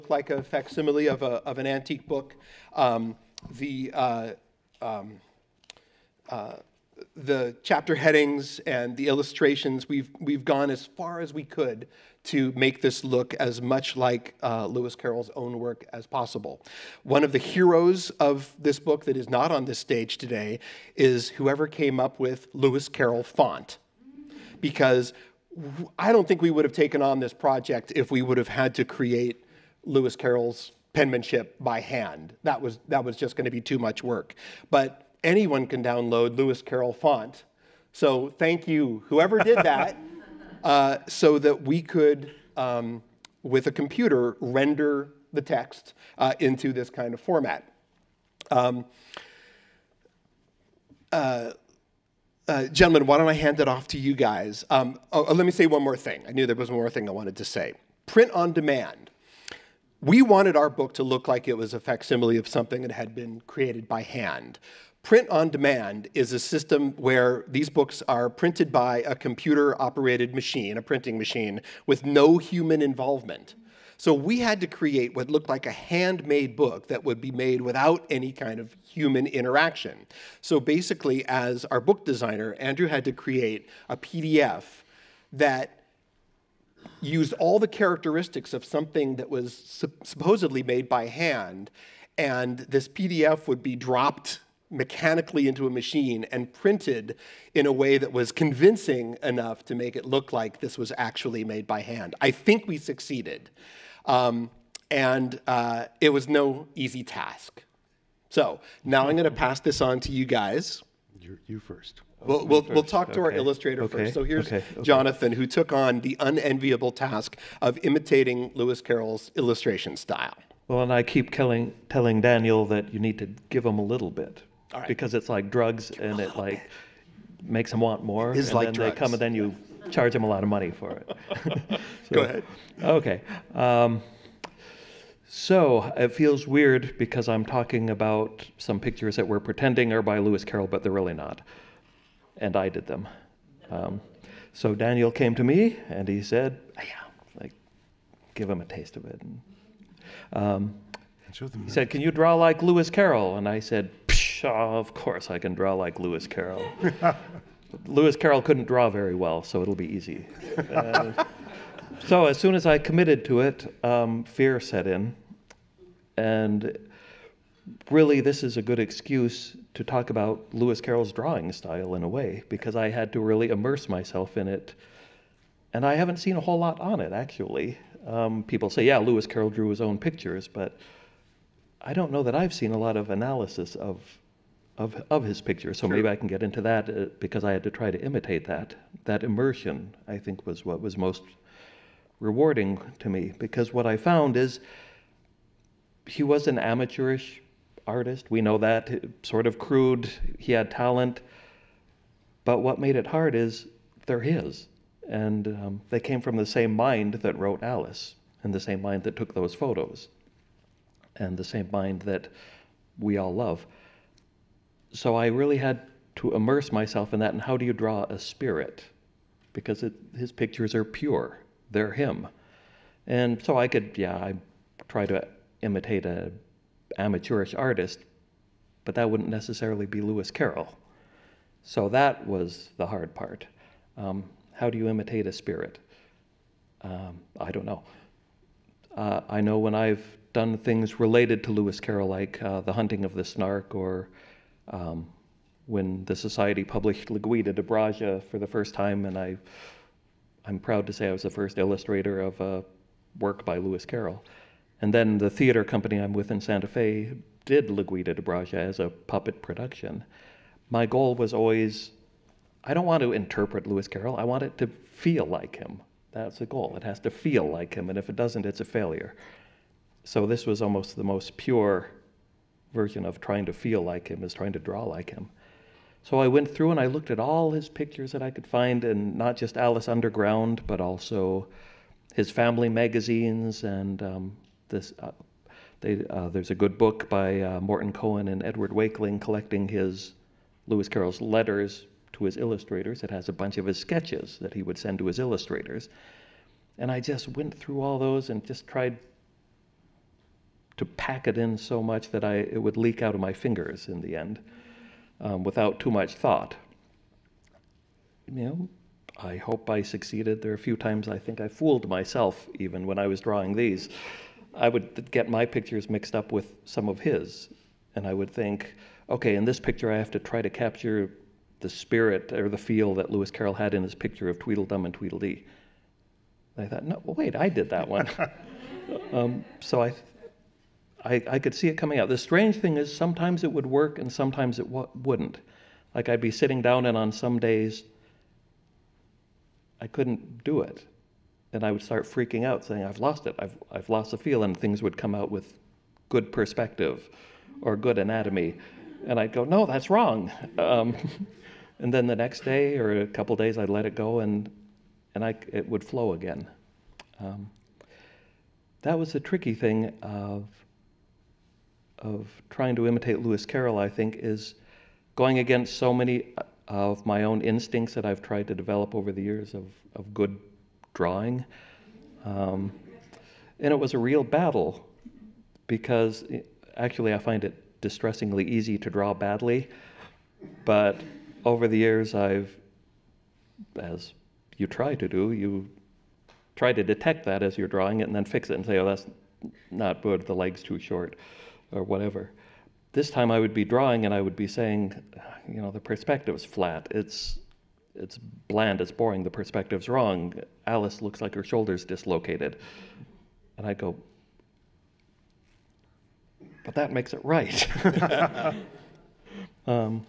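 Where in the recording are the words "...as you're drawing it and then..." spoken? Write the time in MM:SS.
06:27.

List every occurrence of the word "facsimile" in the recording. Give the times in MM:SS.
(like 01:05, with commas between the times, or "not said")
00:00, 01:01.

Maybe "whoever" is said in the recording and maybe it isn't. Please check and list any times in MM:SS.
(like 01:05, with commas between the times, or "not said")
00:21, 00:39.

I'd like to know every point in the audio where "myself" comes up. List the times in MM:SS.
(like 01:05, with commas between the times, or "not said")
02:53, 03:36, 05:11.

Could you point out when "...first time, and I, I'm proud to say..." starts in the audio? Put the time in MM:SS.
04:08.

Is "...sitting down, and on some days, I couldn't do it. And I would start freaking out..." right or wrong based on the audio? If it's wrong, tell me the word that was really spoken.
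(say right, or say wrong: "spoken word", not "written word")
right.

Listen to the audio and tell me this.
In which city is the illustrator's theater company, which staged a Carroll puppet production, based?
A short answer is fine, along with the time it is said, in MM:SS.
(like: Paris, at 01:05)
Santa Fe, at 04:16.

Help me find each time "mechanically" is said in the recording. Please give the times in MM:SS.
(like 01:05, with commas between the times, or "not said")
01:34.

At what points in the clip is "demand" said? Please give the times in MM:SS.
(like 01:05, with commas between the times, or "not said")
00:58, 01:05.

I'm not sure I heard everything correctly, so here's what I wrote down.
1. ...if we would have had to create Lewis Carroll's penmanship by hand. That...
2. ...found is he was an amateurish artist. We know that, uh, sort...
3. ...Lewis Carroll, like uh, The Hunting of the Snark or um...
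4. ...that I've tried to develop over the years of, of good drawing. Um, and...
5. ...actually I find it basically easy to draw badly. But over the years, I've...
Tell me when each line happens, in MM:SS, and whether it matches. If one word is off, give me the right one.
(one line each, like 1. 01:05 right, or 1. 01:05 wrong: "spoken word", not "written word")
1. 00:27 right
2. 03:13 right
3. 04:01 right
4. 06:07 right
5. 06:16 wrong: "distressingly", not "basically".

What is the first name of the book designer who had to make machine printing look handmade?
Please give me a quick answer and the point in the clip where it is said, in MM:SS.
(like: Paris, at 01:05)
Andrew, at 01:22.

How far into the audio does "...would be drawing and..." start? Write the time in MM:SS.
06:33.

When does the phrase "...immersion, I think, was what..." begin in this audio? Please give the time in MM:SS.
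03:09.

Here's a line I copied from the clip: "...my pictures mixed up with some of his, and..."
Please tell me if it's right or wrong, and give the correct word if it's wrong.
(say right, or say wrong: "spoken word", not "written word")
right.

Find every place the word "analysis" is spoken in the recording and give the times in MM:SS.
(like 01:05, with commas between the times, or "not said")
03:03.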